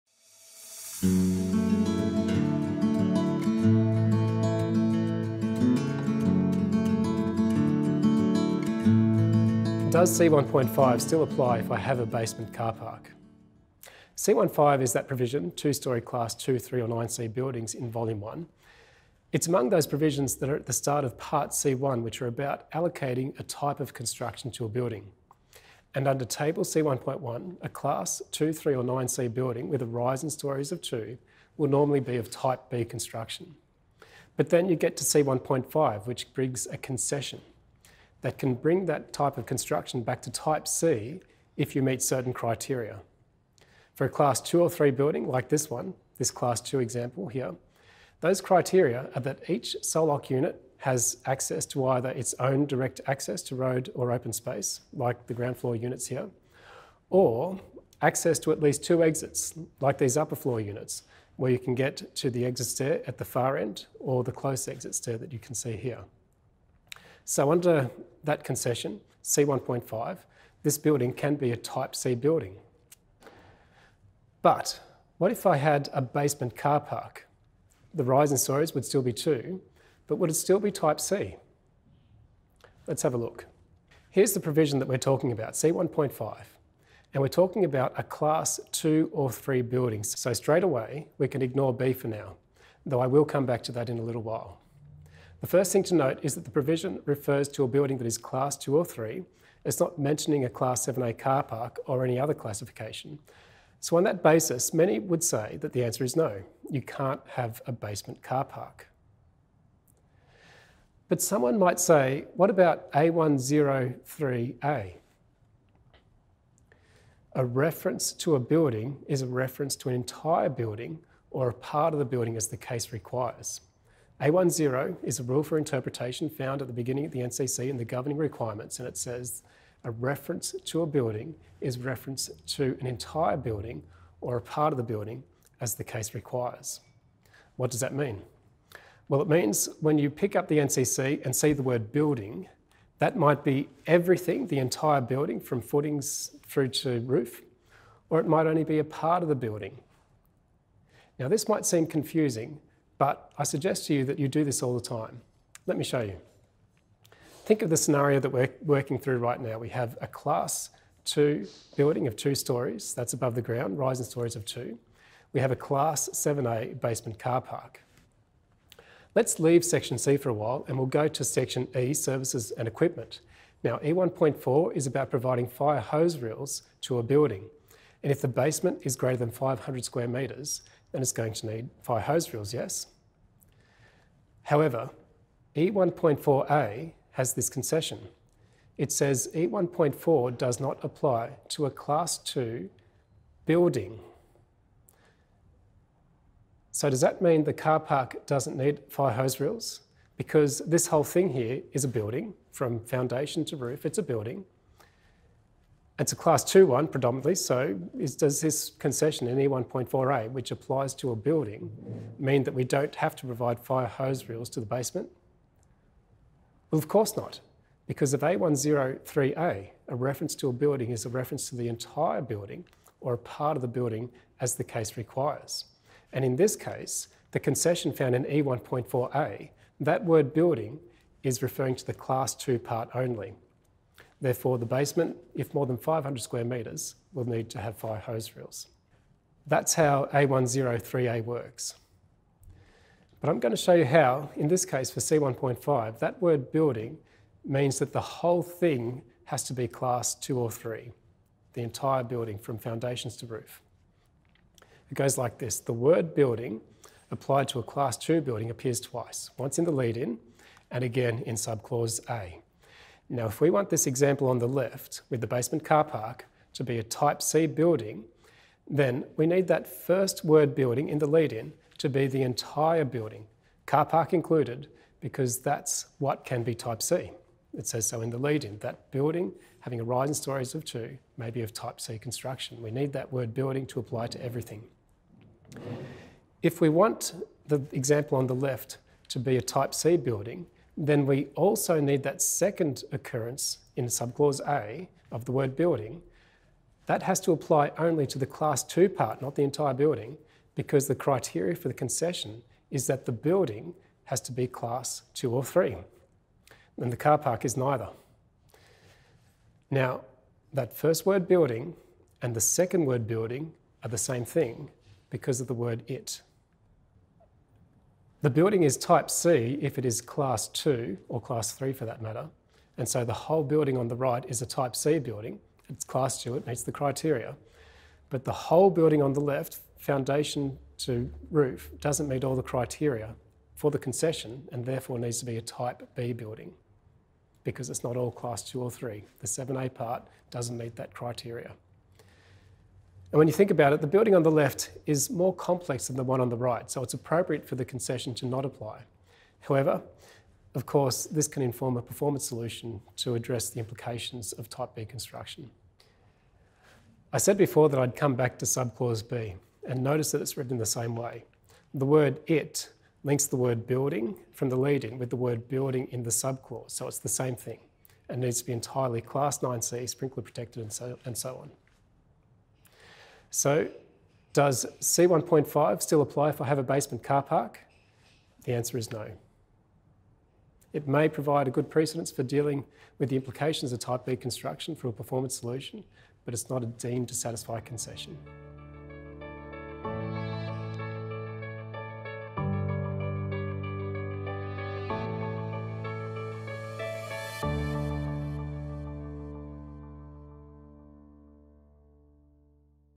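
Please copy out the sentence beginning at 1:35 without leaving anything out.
The first thing to note is that the provision refers to a building that is class two or three.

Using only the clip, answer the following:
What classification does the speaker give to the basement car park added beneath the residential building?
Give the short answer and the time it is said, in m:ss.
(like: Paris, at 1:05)
Class 7A, at 2:45.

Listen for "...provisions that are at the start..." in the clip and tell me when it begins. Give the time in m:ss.
0:19.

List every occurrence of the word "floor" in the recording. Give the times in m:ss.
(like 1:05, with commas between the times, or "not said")
0:55, 1:00.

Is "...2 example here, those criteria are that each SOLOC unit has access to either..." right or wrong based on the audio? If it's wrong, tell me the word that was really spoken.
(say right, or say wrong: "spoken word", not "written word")
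right.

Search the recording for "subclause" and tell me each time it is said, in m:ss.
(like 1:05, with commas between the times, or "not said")
4:21, 4:53, 5:58, 6:06.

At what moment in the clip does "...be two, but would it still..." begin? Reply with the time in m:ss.
1:19.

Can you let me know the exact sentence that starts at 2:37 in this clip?
Think of the scenario that we're working through right now.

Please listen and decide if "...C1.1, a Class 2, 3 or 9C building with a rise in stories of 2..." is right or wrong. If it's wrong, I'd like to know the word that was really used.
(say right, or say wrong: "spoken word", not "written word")
right.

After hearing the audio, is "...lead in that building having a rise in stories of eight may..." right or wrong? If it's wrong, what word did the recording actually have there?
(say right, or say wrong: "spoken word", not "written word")
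wrong: "two", not "eight".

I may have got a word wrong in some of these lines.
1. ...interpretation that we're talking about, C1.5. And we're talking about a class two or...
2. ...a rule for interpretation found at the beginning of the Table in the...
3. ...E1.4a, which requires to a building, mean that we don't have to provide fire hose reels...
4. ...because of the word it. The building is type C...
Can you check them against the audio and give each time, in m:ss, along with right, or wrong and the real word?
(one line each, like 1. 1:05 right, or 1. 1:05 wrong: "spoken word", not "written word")
1. 1:24 wrong: "provision", not "interpretation"
2. 2:05 wrong: "NCC", not "Table"
3. 3:29 wrong: "applies", not "requires"
4. 5:15 right.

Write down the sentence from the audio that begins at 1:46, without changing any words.
You can't have a basement car park.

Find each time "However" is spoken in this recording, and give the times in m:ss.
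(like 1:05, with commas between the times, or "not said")
3:04, 5:49.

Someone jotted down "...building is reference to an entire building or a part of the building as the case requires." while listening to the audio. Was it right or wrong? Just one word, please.
right.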